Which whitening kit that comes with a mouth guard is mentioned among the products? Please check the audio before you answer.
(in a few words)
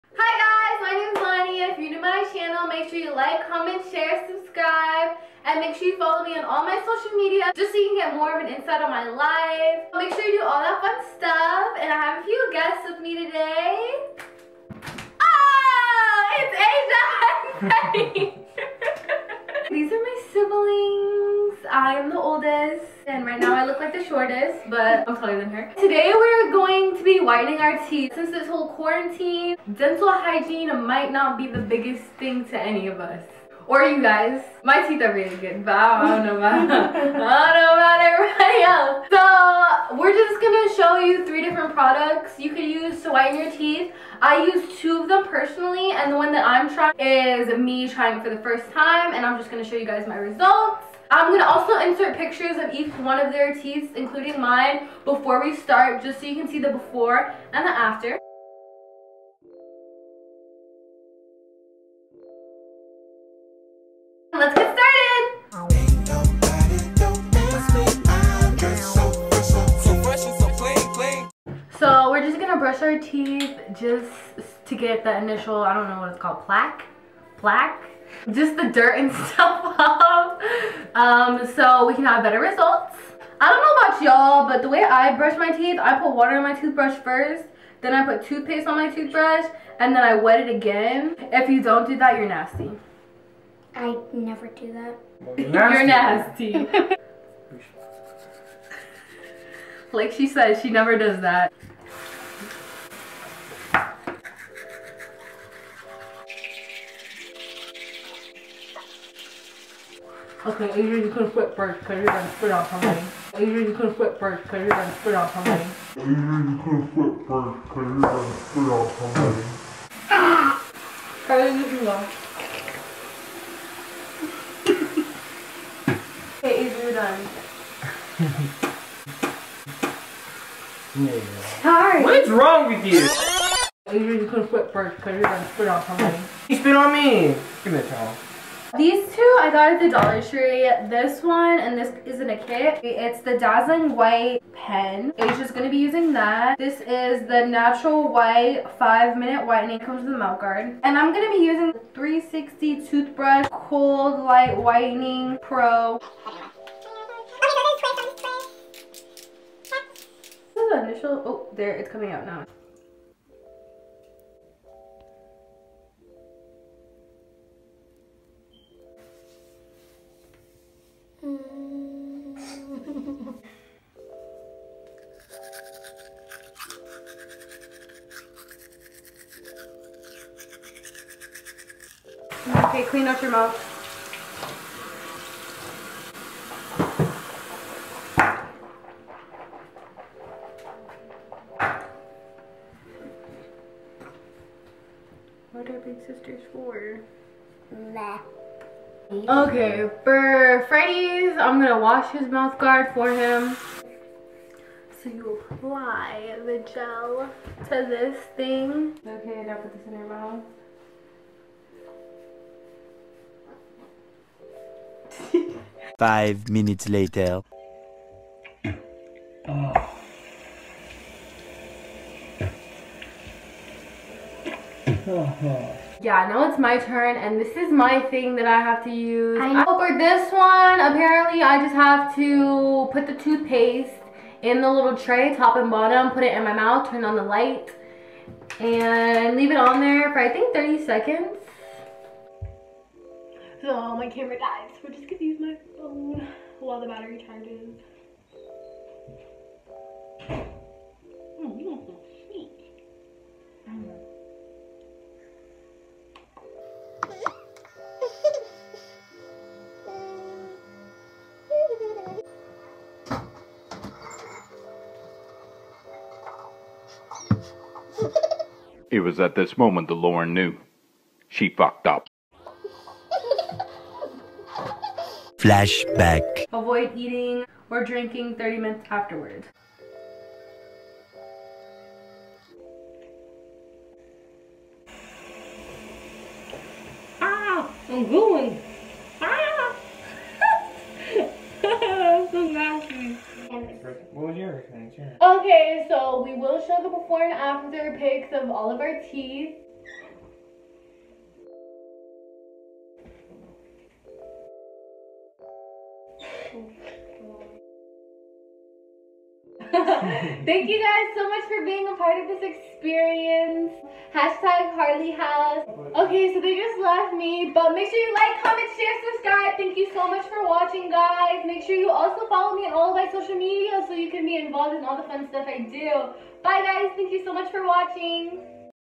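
Natural White 5 Minute Whitening.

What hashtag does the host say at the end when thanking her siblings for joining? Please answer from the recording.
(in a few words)
Harley House.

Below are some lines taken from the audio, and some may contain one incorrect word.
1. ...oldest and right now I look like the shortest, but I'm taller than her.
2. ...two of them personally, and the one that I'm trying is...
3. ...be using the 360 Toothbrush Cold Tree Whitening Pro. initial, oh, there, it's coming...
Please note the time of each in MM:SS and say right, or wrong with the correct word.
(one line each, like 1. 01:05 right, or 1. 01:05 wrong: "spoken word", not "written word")
1. 00:22 right
2. 00:44 right
3. 02:31 wrong: "Light", not "Tree".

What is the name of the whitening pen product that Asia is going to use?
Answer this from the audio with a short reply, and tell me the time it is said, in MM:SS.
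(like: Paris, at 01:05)
Dazzling White Pen, at 02:23.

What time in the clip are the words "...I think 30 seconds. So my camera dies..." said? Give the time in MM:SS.
04:00.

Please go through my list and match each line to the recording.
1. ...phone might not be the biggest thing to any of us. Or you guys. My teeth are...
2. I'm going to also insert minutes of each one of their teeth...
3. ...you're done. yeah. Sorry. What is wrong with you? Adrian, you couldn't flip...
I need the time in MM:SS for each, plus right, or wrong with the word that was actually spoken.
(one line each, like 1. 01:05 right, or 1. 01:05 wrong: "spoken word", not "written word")
1. 00:30 wrong: "hygiene", not "phone"
2. 00:51 wrong: "pictures", not "minutes"
3. 02:06 right.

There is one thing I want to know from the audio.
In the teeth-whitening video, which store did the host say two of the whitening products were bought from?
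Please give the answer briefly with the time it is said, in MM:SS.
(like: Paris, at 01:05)
Dollar Tree, at 02:19.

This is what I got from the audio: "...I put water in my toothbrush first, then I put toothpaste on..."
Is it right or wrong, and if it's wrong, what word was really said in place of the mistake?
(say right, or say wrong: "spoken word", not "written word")
right.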